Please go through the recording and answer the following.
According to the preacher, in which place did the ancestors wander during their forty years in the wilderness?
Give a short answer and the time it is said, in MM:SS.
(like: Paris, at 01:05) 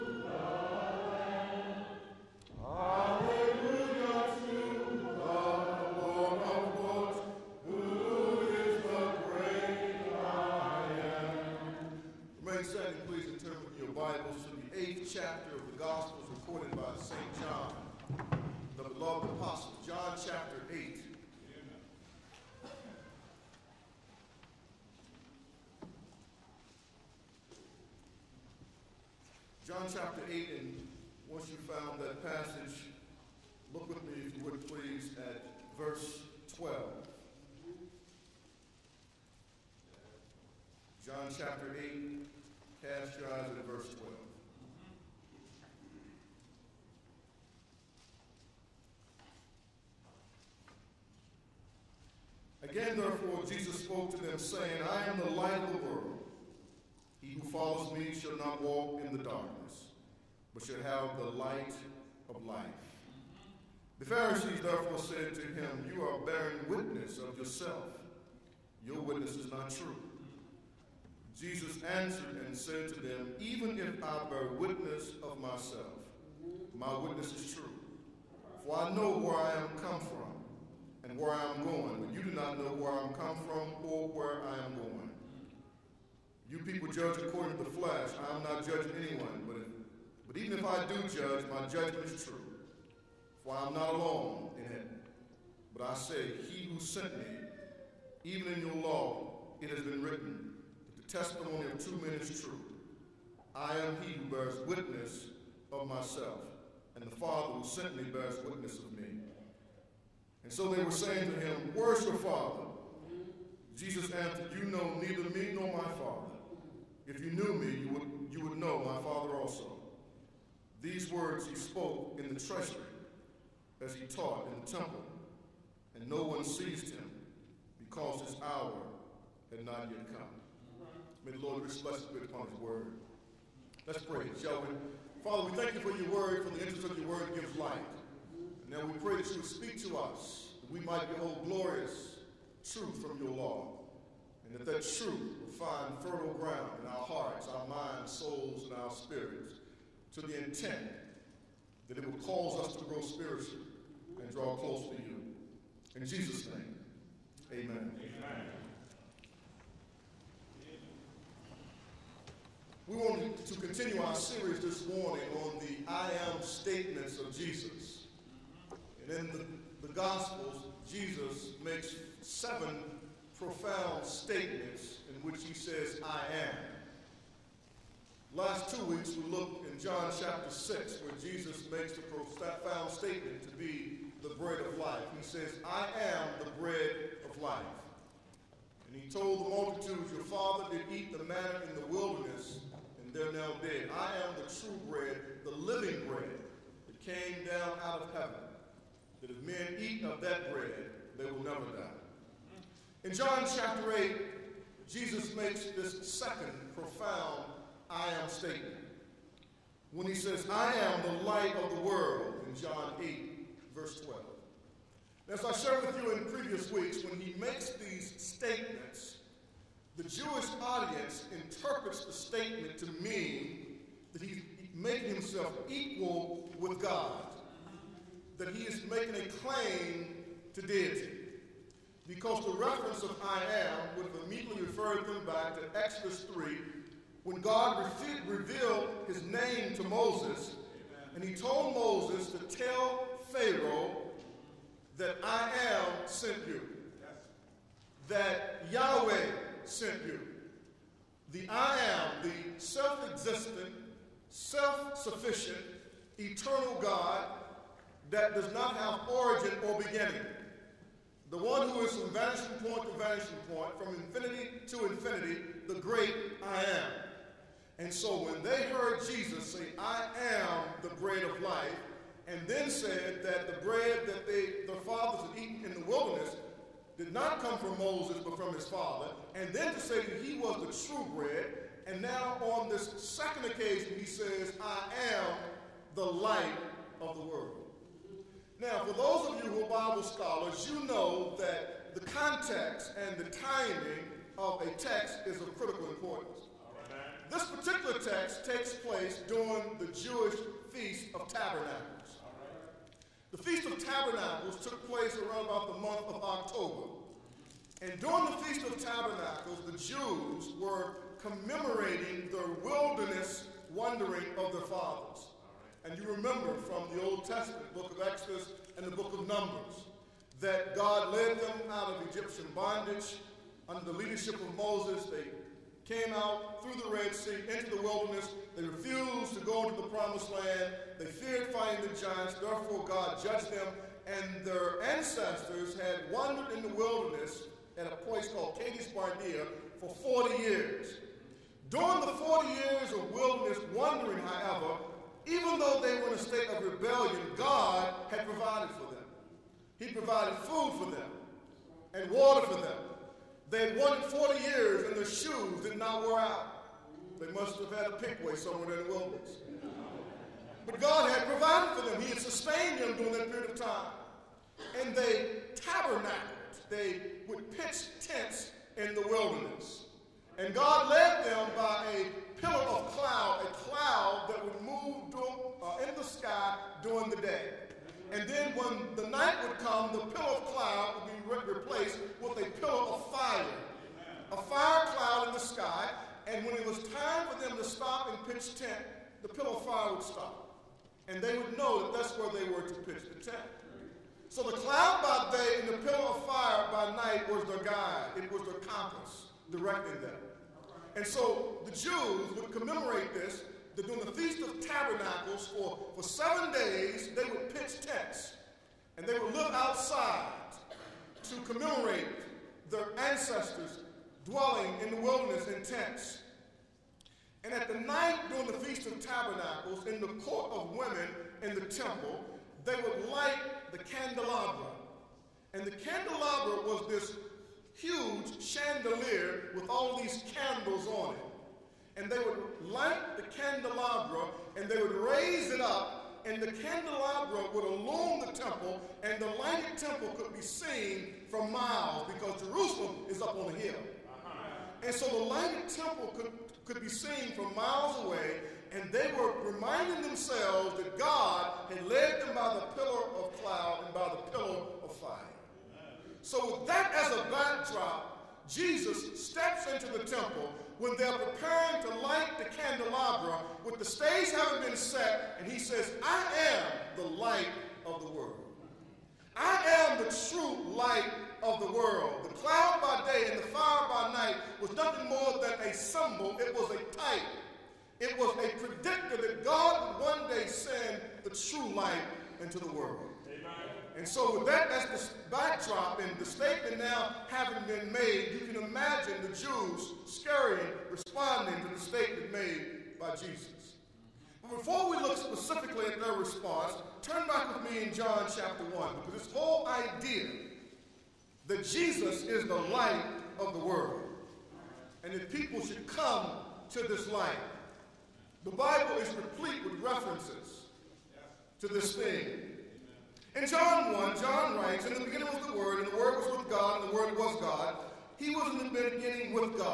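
Kadesh Barnea, at 05:38.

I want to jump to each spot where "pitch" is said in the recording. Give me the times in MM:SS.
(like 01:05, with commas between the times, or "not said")
06:07, 06:28, 06:32, 06:47.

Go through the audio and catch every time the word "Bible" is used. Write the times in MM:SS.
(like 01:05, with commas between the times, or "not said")
04:49, 08:28.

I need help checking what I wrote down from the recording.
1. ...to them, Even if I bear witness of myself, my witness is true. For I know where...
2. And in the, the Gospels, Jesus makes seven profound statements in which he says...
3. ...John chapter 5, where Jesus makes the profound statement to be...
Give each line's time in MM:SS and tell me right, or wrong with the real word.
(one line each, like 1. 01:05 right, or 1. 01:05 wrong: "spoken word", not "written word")
1. 01:12 right
2. 02:49 right
3. 02:59 wrong: "6", not "5".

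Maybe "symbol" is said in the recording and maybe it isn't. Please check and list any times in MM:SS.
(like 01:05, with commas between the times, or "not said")
07:55.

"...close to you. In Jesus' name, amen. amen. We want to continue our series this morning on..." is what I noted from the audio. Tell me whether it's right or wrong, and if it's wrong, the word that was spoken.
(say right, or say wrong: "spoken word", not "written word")
right.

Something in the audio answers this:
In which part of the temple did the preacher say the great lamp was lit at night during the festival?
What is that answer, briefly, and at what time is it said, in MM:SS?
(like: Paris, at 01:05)
court of women, at 07:00.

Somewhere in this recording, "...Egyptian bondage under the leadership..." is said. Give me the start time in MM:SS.
05:22.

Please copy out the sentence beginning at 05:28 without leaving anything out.
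They refused to go into the promised land.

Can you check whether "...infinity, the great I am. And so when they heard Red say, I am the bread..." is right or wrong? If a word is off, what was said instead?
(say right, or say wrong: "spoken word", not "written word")
wrong: "Jesus", not "Red".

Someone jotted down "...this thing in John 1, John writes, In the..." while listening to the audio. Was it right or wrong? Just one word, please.
right.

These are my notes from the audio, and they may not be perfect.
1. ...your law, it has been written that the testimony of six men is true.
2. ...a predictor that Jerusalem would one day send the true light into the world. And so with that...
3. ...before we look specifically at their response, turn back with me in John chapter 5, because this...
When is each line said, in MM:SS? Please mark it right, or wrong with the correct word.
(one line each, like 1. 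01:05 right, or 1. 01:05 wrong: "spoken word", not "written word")
1. 01:38 wrong: "two", not "six"
2. 07:58 wrong: "God", not "Jerusalem"
3. 08:14 wrong: "1", not "5".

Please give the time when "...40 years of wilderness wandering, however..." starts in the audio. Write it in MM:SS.
05:42.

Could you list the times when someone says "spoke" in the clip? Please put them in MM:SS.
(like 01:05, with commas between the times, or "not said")
00:53, 02:01.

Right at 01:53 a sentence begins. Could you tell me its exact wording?
Jesus answered, You know neither me nor my Father.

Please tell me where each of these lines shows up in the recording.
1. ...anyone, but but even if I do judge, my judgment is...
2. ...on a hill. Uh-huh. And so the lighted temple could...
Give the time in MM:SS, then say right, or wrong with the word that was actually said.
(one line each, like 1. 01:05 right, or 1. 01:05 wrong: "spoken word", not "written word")
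1. 01:29 right
2. 07:23 right.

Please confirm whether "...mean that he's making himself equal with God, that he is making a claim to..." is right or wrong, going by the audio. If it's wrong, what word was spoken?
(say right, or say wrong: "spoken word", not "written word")
right.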